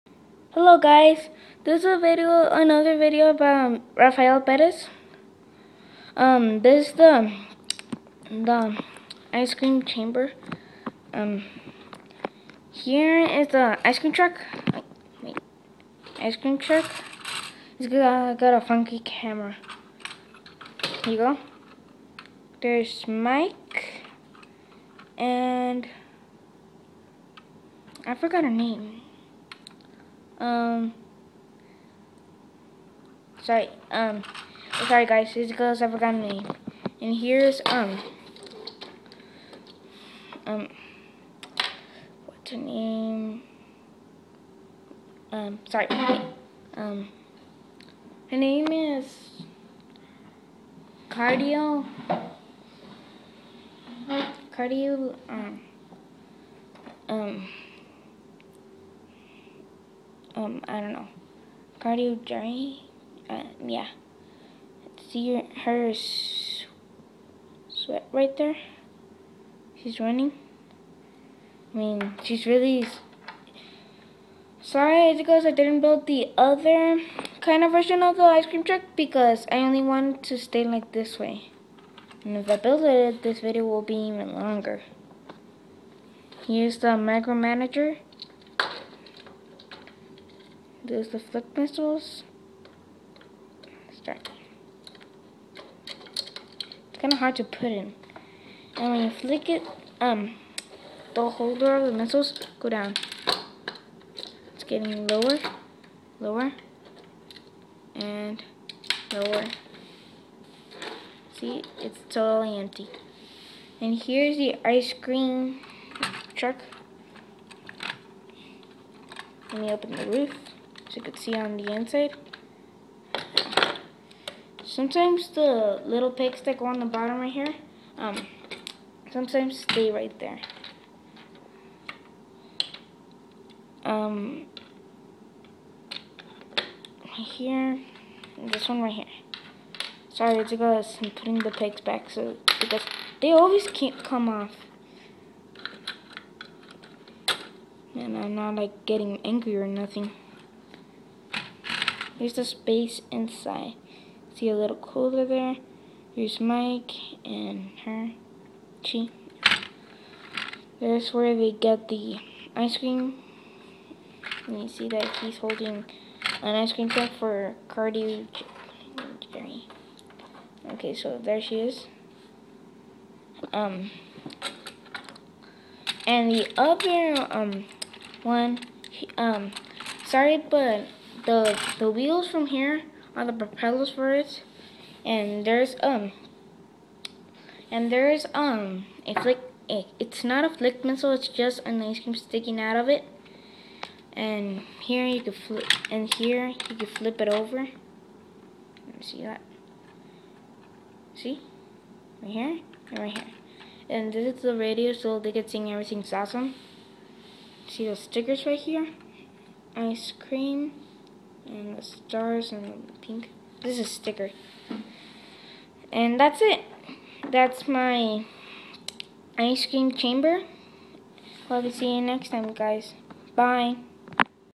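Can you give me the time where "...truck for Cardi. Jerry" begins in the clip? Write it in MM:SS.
02:46.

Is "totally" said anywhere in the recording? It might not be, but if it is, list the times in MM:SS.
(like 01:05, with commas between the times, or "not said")
01:52.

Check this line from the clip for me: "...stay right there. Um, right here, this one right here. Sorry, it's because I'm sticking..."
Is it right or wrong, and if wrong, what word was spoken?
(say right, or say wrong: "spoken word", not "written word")
wrong: "putting", not "sticking".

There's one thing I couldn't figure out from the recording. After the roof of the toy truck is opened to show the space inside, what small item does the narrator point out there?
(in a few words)
Cooler.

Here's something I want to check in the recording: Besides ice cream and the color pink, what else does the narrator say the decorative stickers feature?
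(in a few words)
Stars.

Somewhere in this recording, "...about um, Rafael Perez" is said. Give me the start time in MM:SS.
00:03.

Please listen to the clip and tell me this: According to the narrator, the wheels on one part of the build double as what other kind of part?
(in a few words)
Propellers.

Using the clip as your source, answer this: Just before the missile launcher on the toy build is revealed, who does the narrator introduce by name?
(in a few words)
Macro manager.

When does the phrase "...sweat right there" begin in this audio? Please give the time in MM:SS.
01:07.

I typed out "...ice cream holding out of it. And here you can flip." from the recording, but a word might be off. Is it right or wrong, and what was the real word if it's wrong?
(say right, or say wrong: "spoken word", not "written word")
wrong: "sticking", not "holding".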